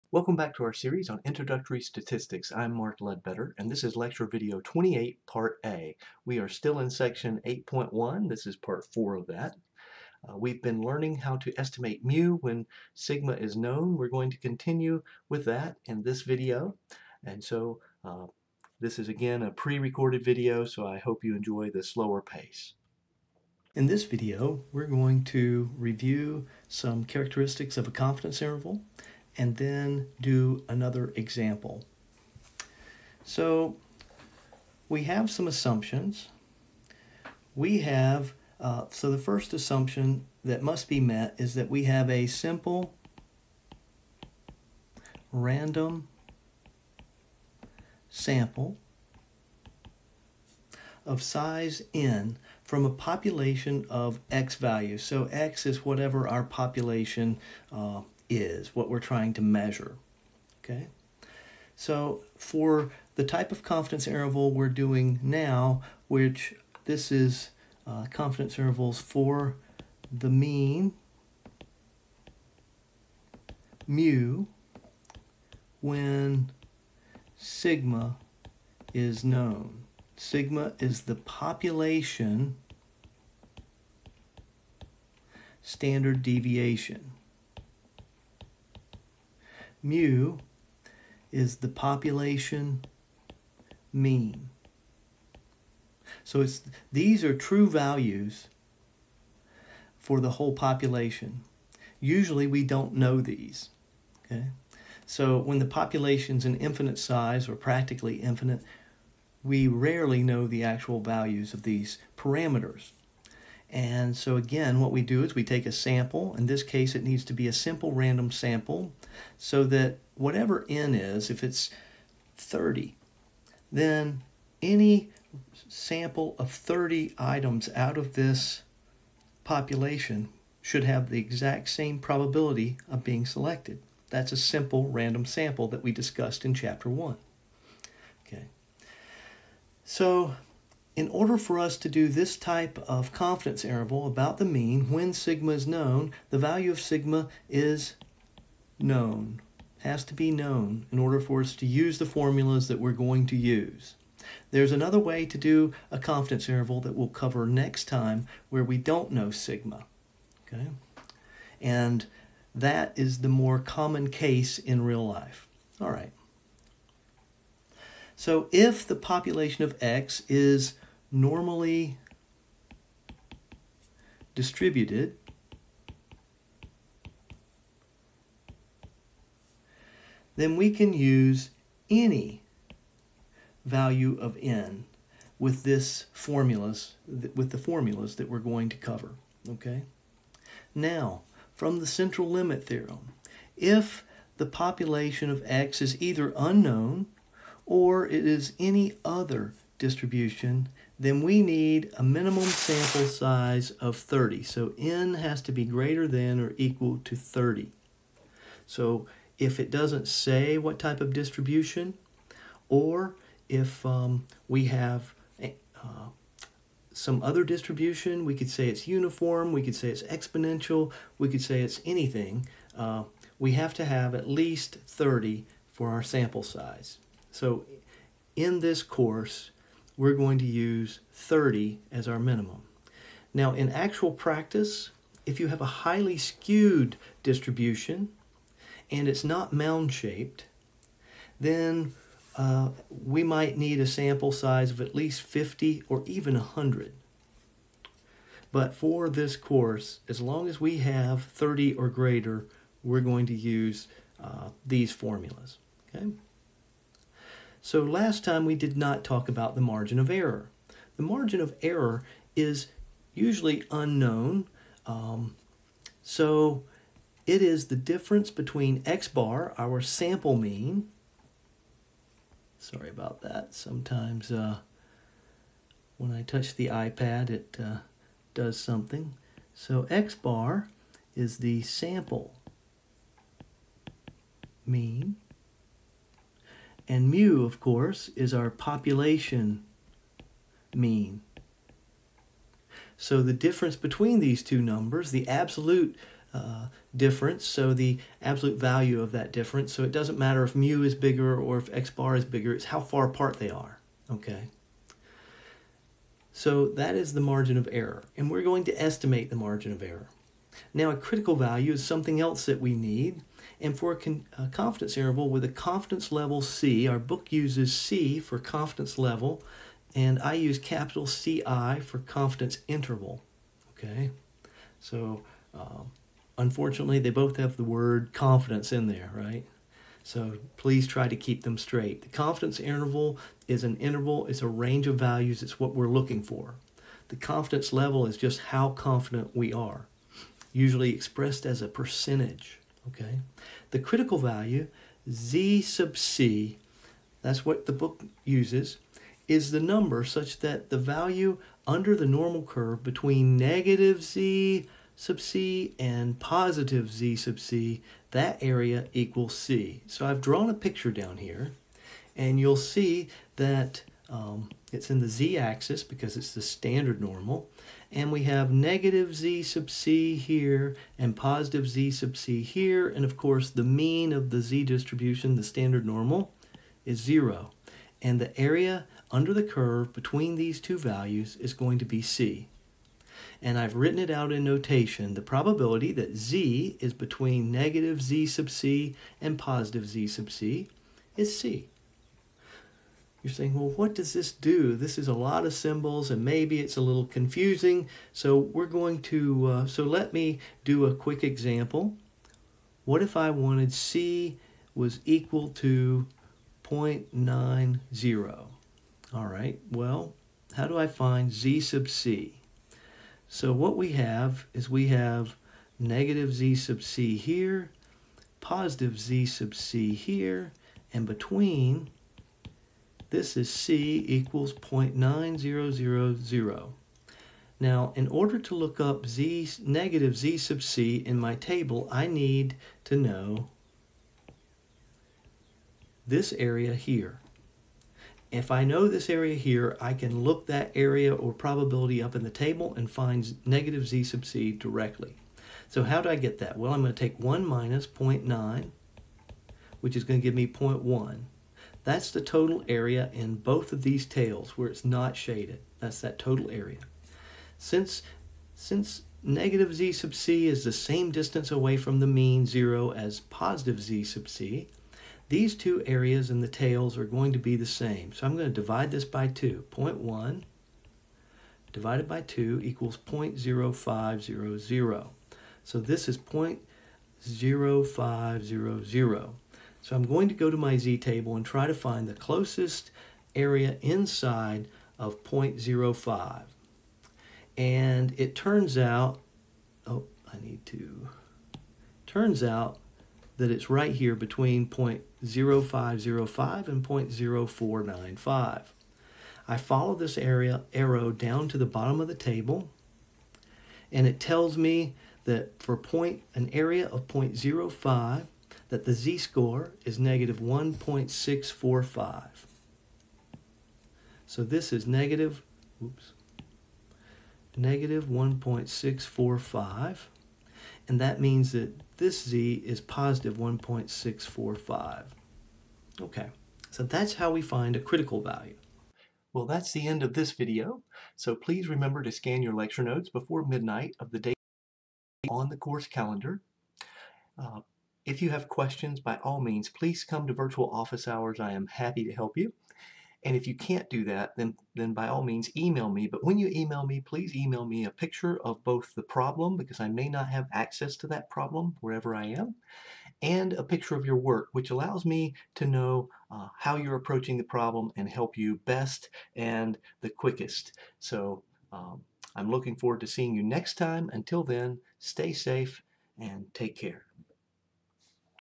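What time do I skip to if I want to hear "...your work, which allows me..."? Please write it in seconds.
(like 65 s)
554 s.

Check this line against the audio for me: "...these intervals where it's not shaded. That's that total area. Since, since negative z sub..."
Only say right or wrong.
wrong.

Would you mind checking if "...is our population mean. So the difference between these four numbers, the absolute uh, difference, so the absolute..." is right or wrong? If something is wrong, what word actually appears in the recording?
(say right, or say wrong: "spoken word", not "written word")
wrong: "two", not "four".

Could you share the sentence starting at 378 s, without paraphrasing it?
And the area under the curve between these two values is going to be c.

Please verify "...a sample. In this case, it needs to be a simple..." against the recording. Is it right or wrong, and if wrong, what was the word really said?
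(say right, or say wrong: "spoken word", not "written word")
right.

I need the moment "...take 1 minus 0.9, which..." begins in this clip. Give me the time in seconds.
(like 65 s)
446 s.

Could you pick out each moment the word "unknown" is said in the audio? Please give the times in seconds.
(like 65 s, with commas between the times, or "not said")
196 s, 263 s.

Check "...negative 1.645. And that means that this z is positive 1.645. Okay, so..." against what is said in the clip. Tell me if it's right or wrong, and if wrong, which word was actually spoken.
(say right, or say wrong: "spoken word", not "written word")
right.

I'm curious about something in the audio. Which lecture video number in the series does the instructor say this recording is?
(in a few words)
28.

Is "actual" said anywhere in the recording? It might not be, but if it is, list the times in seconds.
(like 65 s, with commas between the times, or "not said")
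110 s, 233 s.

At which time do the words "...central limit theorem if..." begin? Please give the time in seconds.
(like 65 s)
191 s.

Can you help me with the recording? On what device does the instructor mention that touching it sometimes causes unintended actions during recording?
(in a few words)
iPad.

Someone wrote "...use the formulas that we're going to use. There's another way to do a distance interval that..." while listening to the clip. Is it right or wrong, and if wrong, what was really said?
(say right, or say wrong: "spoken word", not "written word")
wrong: "confidence", not "distance".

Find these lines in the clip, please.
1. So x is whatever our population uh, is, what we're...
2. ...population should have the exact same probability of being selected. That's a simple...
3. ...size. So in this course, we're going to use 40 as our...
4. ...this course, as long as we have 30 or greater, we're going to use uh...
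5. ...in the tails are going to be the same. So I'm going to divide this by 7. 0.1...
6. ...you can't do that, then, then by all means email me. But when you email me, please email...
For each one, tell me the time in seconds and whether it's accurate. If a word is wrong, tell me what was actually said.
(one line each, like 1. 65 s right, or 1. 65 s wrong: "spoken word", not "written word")
1. 55 s right
2. 129 s right
3. 226 s wrong: "30", not "40"
4. 249 s right
5. 466 s wrong: "2", not "7"
6. 543 s right.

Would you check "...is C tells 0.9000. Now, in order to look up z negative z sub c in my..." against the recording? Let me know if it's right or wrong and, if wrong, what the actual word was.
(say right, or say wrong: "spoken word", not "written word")
wrong: "equals", not "tells".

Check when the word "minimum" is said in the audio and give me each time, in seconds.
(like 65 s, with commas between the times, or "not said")
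202 s, 232 s.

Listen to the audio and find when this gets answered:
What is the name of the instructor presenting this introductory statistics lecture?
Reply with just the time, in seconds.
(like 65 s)
2 s.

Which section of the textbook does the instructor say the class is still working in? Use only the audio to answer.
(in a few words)
8.1.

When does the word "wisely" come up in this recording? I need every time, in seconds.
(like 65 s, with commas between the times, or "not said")
not said.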